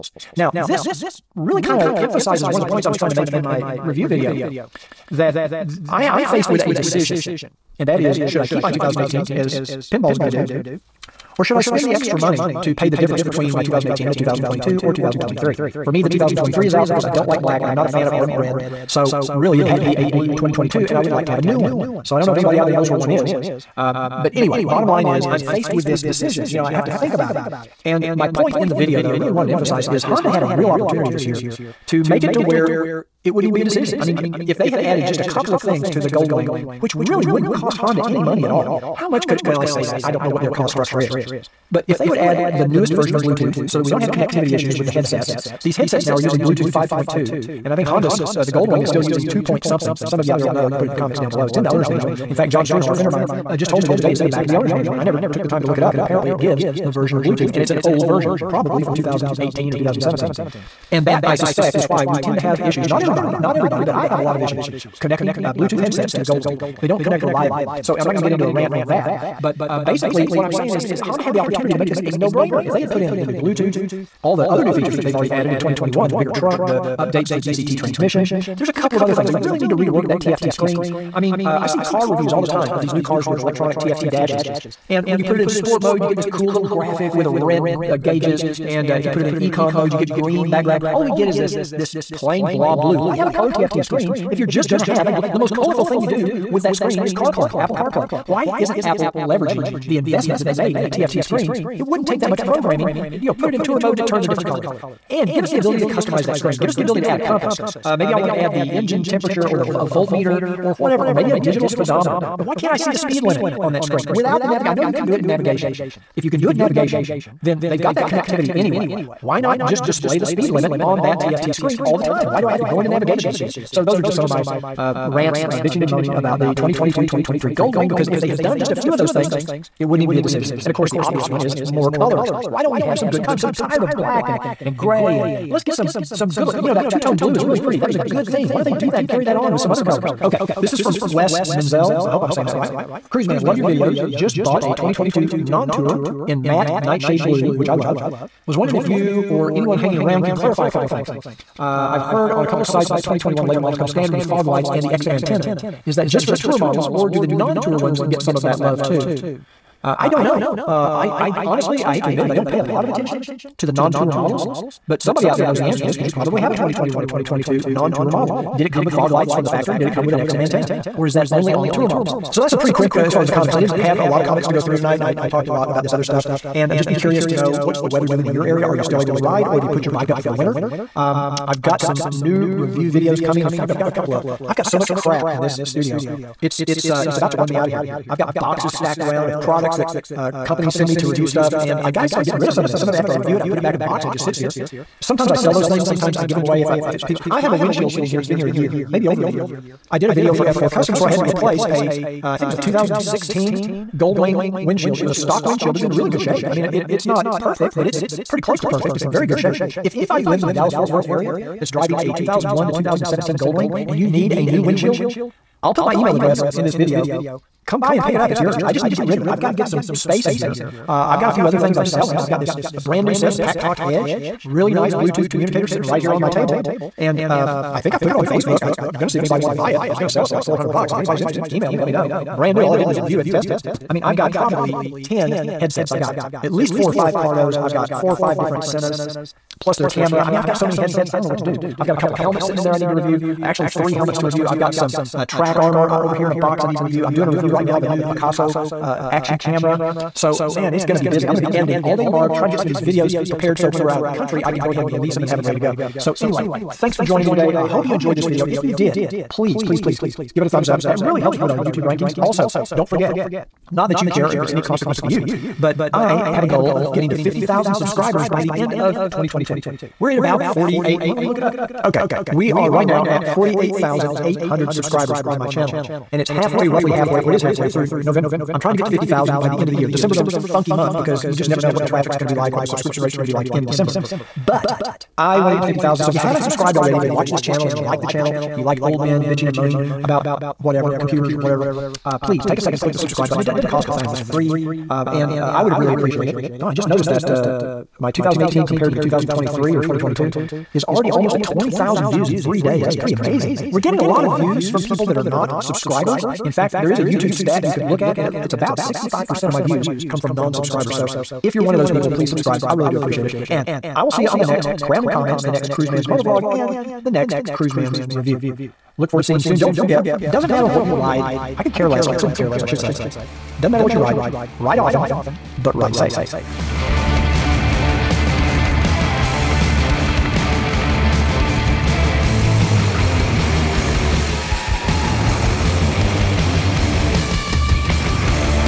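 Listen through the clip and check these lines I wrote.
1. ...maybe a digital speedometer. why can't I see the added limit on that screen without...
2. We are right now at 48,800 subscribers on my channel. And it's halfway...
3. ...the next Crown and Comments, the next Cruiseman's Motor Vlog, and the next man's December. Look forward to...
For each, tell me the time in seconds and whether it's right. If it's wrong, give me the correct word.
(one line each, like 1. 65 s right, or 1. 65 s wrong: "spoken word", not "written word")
1. 111 s wrong: "speed", not "added"
2. 272 s right
3. 314 s wrong: "Review", not "December".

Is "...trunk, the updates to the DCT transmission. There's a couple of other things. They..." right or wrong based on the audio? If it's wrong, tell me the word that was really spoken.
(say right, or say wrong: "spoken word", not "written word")
right.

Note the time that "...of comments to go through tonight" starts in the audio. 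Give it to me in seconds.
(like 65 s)
174 s.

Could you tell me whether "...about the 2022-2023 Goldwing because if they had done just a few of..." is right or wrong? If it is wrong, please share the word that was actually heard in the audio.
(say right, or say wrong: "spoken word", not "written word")
right.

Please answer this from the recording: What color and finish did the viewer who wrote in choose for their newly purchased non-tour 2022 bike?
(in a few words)
Matte nightshade blue.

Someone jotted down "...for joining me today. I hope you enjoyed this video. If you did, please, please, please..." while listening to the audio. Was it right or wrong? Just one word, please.
right.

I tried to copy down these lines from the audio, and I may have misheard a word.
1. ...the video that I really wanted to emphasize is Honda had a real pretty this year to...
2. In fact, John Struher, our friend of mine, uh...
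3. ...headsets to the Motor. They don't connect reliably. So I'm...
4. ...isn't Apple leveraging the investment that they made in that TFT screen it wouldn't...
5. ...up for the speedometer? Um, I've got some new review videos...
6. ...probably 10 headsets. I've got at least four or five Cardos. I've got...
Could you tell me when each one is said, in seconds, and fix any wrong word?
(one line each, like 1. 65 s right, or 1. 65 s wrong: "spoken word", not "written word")
1. 28 s wrong: "opportunity", not "pretty"
2. 52 s right
3. 65 s wrong: "Goldwing", not "Motor"
4. 98 s right
5. 180 s wrong: "winter", not "speedometer"
6. 234 s right.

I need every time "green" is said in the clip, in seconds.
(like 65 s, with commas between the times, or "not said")
90 s.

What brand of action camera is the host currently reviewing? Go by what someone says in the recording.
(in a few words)
Akaso.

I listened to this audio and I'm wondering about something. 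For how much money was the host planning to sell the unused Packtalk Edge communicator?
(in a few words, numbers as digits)
$400.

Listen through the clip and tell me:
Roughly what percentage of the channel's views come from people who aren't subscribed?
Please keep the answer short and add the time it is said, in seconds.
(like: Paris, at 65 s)
65%, at 308 s.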